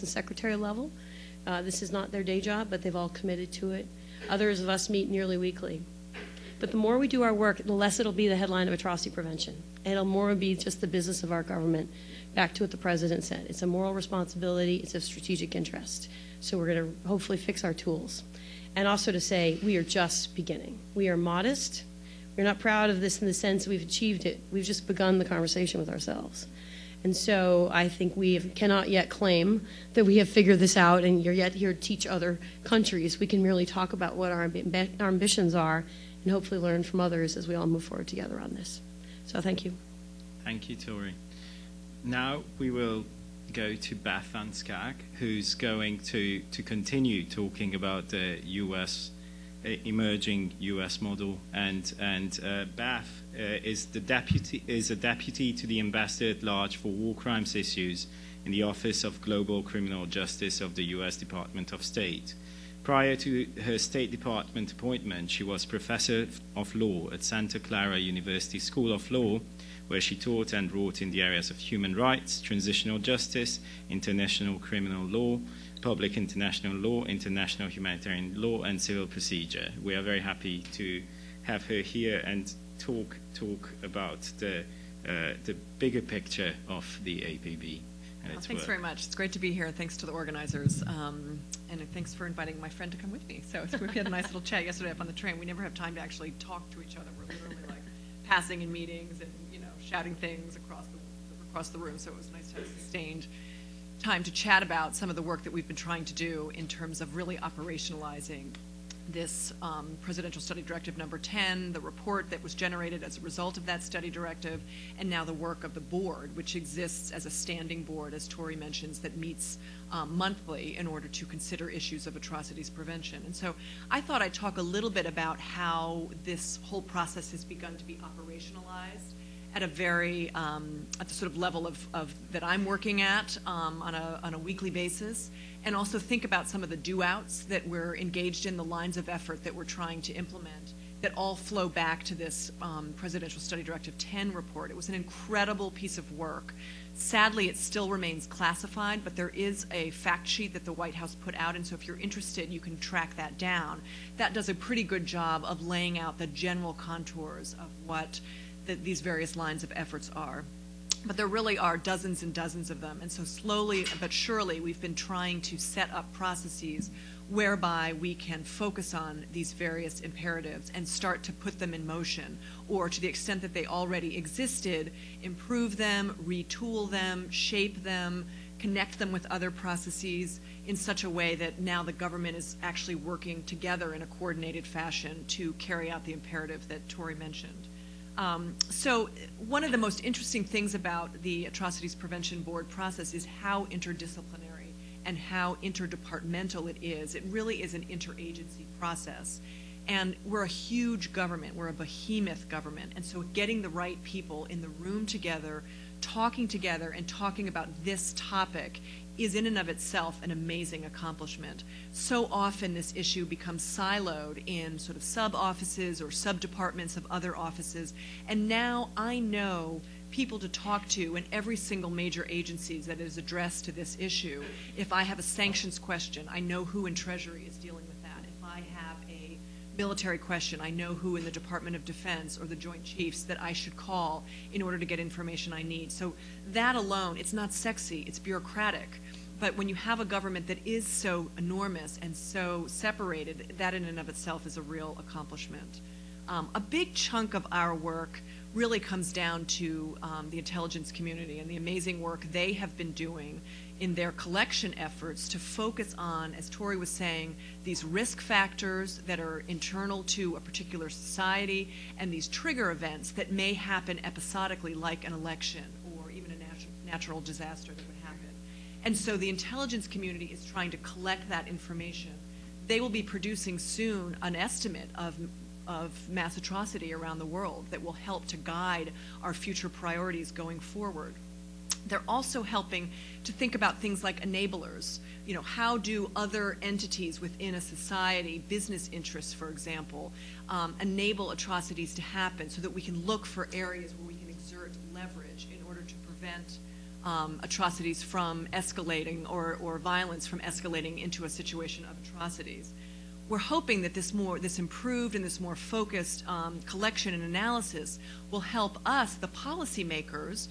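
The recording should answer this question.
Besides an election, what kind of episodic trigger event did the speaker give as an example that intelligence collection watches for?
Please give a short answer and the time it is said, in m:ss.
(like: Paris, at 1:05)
natural disaster, at 4:26.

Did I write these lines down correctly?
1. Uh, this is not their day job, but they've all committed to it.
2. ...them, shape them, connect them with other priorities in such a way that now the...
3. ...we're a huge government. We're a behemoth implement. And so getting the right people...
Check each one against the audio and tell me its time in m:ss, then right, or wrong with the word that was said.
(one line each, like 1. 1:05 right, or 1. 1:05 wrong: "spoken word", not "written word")
1. 0:01 right
2. 2:56 wrong: "processes", not "priorities"
3. 3:20 wrong: "government", not "implement".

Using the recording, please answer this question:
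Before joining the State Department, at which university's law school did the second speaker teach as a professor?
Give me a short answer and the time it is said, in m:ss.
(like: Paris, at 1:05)
Santa Clara University, at 1:07.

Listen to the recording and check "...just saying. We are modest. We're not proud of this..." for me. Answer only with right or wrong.
wrong.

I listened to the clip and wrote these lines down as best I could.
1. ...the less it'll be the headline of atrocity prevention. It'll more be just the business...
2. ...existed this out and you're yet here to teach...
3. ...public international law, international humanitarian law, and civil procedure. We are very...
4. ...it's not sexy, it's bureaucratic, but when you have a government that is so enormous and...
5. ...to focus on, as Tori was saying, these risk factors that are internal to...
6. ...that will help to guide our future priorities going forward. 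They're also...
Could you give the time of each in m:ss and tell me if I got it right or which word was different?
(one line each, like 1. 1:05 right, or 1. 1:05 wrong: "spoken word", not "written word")
1. 0:07 right
2. 0:30 wrong: "figured", not "existed"
3. 1:15 right
4. 3:57 right
5. 4:15 right
6. 4:37 right.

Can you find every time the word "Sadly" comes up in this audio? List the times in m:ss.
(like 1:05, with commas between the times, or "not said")
2:26.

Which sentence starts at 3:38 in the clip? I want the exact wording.
And now I know people to talk to in every single major agency that is addressed to this issue.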